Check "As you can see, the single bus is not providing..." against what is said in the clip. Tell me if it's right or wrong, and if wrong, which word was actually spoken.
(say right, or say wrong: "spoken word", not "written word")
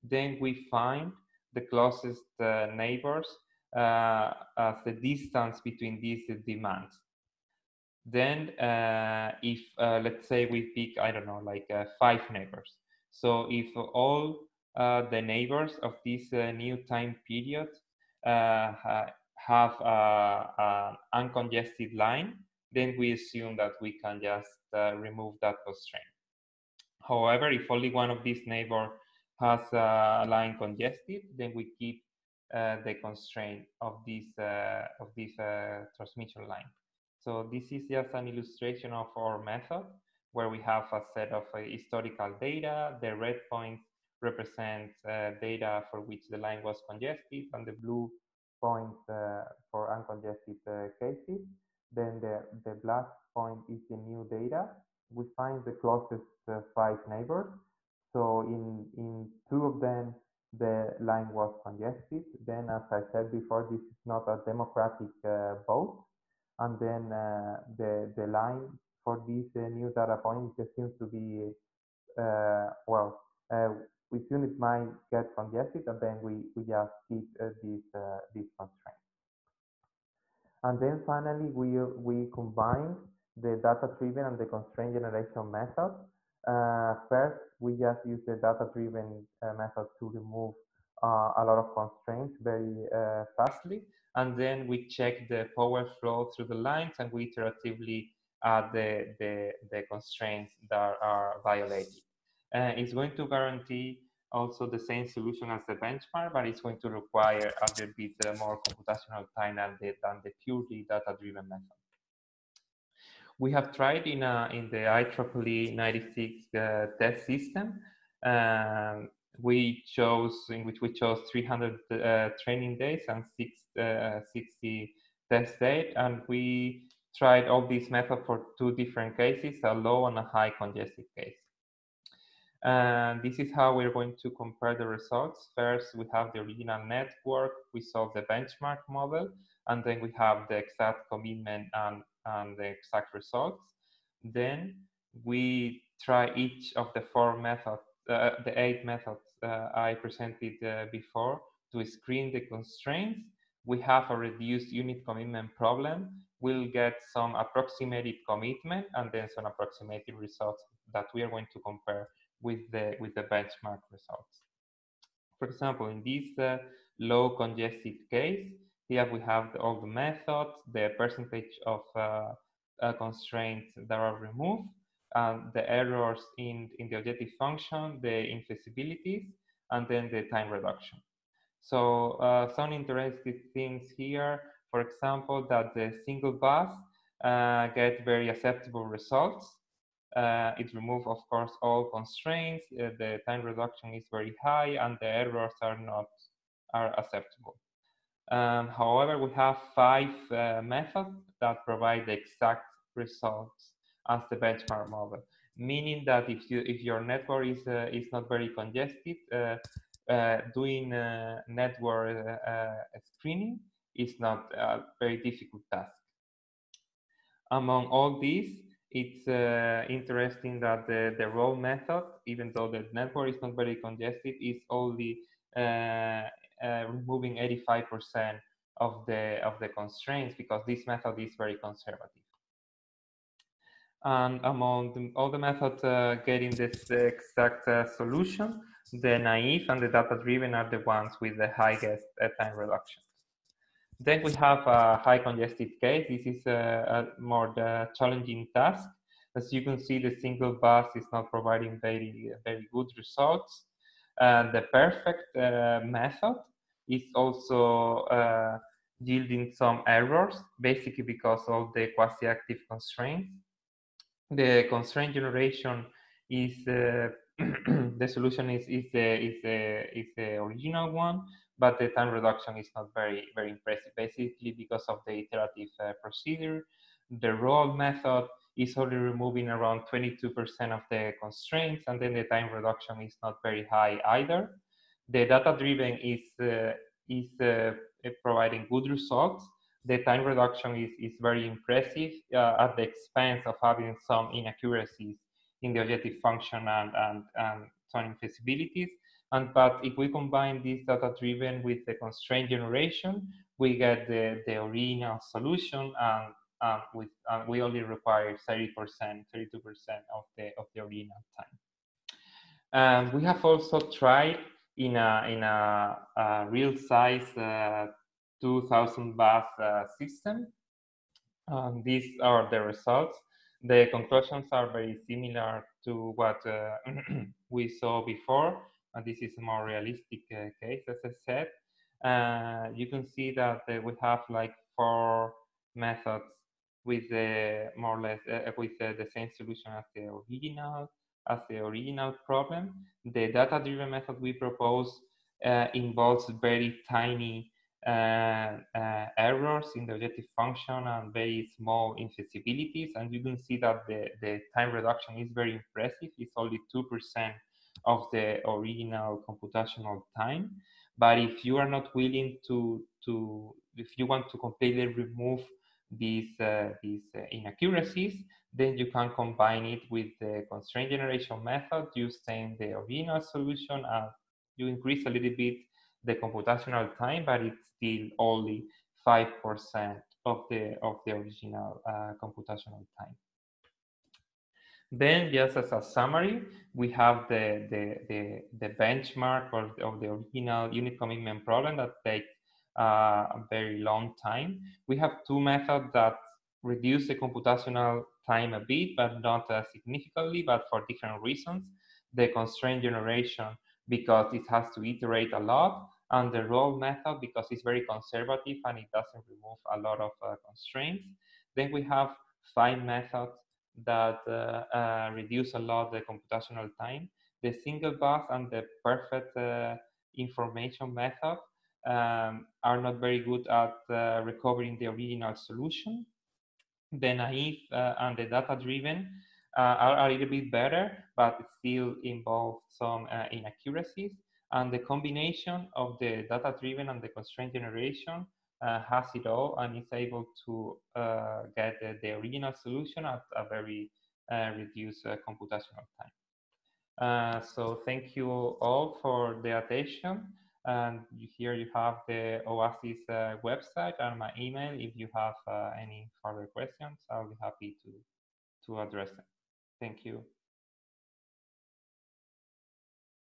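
right.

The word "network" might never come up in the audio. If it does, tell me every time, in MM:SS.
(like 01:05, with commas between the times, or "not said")
02:16, 03:27, 03:31, 03:42.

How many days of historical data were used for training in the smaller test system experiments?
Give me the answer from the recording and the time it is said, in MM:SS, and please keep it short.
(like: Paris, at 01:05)
300, at 02:01.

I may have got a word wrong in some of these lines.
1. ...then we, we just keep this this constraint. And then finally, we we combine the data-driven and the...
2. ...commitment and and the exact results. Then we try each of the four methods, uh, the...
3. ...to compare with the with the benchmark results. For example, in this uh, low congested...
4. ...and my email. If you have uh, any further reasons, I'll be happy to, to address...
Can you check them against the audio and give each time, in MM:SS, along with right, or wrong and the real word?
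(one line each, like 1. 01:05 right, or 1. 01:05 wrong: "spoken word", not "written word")
1. 01:15 right
2. 02:21 right
3. 02:41 right
4. 07:33 wrong: "questions", not "reasons".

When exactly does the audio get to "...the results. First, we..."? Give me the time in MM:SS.
02:14.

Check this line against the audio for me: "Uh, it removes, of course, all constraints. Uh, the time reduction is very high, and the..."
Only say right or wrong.
right.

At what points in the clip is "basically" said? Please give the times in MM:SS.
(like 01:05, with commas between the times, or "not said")
04:20, 04:33.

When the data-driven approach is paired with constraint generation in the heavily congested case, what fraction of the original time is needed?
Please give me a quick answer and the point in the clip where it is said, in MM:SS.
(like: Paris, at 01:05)
32%, at 05:09.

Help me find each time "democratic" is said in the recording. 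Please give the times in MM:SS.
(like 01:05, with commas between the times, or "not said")
01:04.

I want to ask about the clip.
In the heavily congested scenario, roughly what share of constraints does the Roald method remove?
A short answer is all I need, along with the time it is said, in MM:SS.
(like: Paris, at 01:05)
22%, at 04:39.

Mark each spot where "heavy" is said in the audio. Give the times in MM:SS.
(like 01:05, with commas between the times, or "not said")
not said.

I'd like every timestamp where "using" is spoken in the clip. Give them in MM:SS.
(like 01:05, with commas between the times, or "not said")
06:11.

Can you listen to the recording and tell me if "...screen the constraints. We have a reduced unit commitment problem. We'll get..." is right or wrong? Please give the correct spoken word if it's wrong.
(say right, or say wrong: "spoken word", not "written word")
right.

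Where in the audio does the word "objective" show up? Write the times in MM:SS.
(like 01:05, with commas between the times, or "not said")
02:56, 04:55, 05:49.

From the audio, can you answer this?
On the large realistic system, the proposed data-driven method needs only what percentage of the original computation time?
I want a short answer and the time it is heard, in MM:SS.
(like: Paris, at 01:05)
2%, at 05:56.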